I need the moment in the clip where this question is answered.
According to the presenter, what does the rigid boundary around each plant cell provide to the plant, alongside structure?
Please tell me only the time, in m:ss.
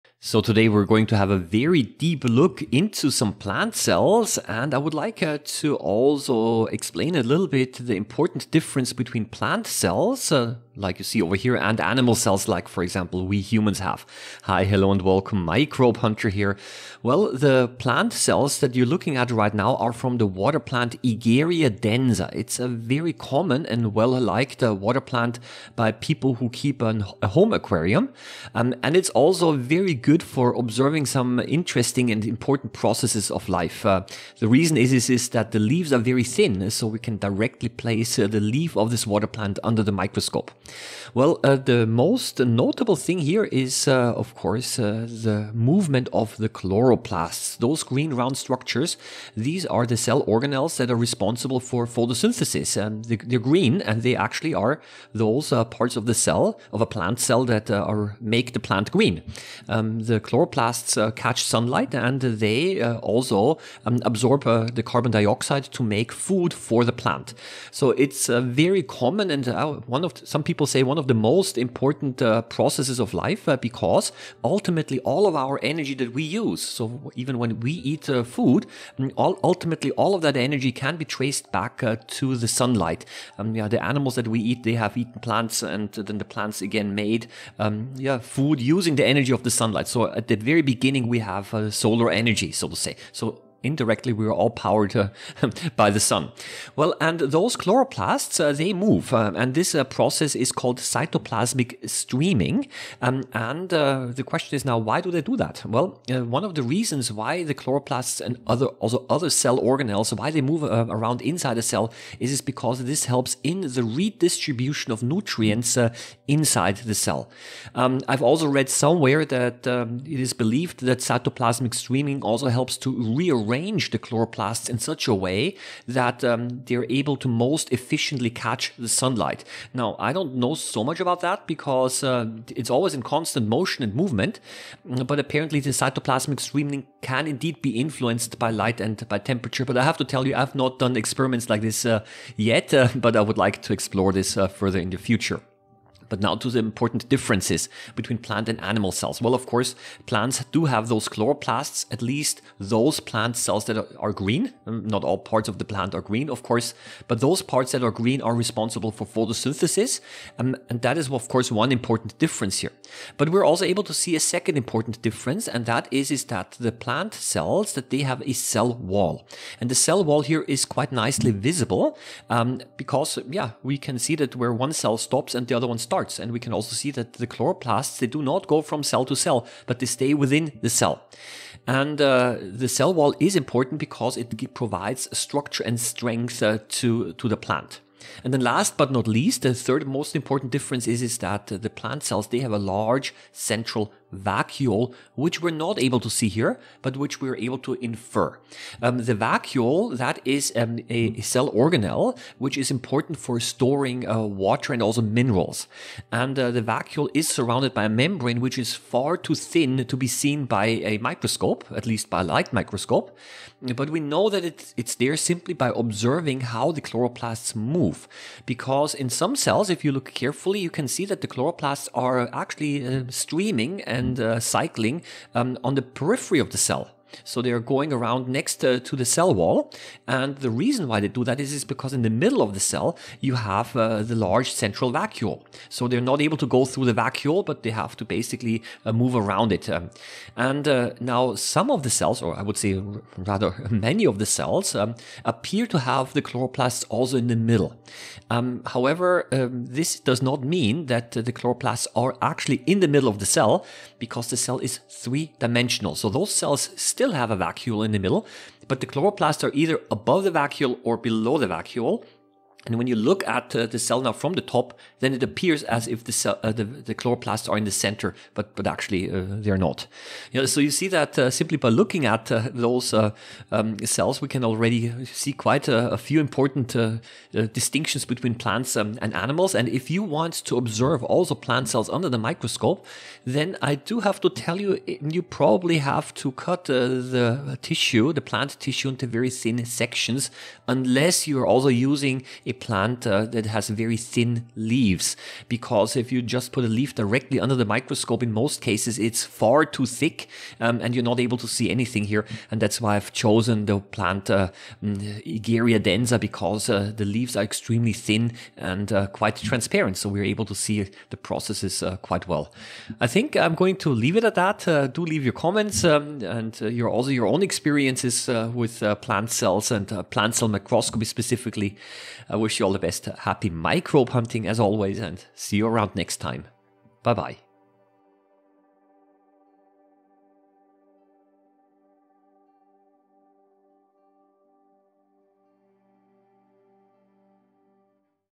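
3:05.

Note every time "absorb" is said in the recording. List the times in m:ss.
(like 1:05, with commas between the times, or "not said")
1:04.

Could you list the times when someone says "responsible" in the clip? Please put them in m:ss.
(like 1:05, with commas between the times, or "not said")
0:50, 2:38.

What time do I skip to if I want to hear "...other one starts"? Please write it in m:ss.
2:55.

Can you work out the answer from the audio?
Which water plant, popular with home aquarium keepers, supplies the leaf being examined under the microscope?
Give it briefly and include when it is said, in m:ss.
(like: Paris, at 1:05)
Egeria densa, at 0:21.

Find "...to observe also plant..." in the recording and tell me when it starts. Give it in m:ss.
4:40.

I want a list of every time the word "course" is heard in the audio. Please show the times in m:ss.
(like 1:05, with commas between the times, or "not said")
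0:44, 2:29, 2:36, 2:41.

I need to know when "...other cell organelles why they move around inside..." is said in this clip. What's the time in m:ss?
1:49.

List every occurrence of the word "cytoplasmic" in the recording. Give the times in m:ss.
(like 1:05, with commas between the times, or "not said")
1:40, 2:00, 2:15.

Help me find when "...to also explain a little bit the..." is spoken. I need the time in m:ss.
0:05.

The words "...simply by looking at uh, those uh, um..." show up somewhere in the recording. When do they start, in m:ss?
4:31.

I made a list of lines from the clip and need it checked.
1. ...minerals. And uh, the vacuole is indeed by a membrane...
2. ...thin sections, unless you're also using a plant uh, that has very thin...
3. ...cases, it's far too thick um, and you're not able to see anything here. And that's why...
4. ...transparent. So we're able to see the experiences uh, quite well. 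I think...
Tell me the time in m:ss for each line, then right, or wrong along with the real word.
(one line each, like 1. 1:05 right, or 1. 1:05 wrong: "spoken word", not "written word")
1. 3:25 wrong: "surrounded", not "indeed"
2. 4:49 right
3. 4:58 right
4. 5:09 wrong: "processes", not "experiences".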